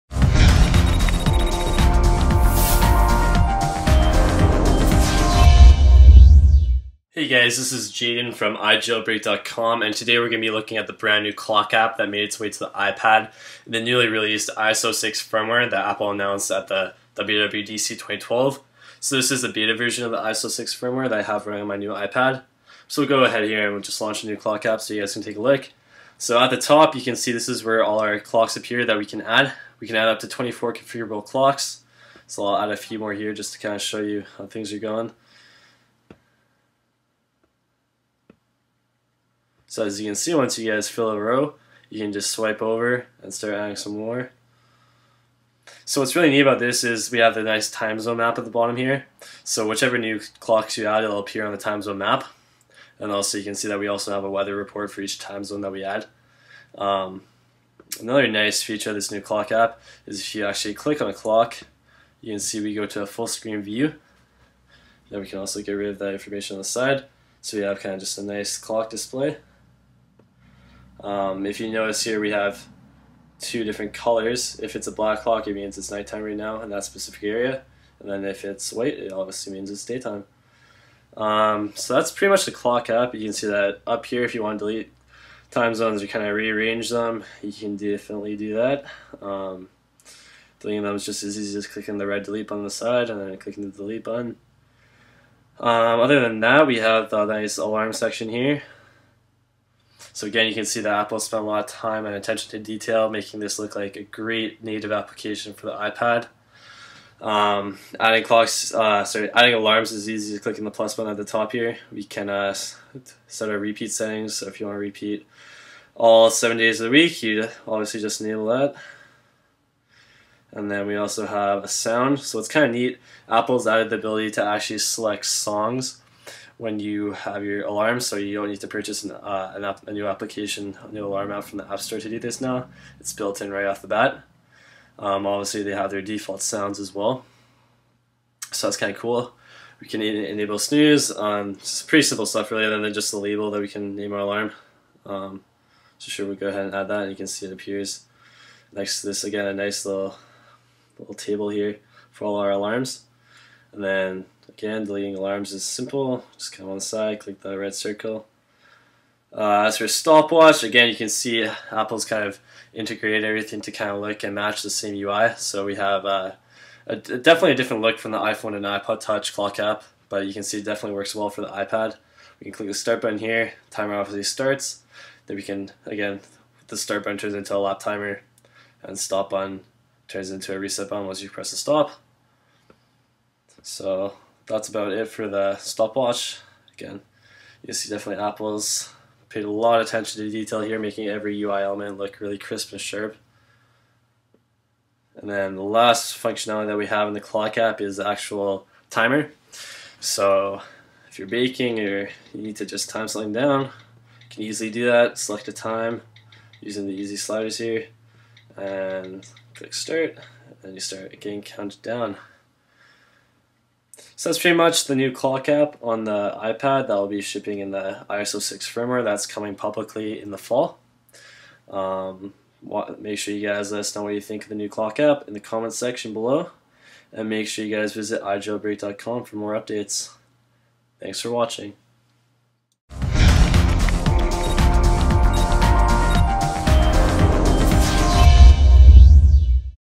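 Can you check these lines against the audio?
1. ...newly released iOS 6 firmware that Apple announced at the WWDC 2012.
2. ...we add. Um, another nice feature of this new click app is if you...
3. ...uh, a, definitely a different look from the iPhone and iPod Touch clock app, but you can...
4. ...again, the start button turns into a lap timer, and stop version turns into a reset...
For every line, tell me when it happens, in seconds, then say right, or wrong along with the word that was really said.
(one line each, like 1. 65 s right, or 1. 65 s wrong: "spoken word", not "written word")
1. 13 s right
2. 55 s wrong: "clock", not "click"
3. 166 s right
4. 175 s wrong: "button", not "version".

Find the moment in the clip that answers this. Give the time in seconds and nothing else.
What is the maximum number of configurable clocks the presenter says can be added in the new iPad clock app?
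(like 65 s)
30 s.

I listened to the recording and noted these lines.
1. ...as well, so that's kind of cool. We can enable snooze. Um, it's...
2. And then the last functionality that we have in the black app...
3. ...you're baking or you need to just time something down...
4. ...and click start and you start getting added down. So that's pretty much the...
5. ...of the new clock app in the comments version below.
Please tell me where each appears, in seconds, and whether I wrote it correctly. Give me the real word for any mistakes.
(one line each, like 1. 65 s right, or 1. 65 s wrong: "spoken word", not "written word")
1. 136 s right
2. 195 s wrong: "clock", not "black"
3. 201 s right
4. 208 s wrong: "counted", not "added"
5. 224 s wrong: "section", not "version".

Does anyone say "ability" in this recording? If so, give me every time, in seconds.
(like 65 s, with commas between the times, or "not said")
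123 s.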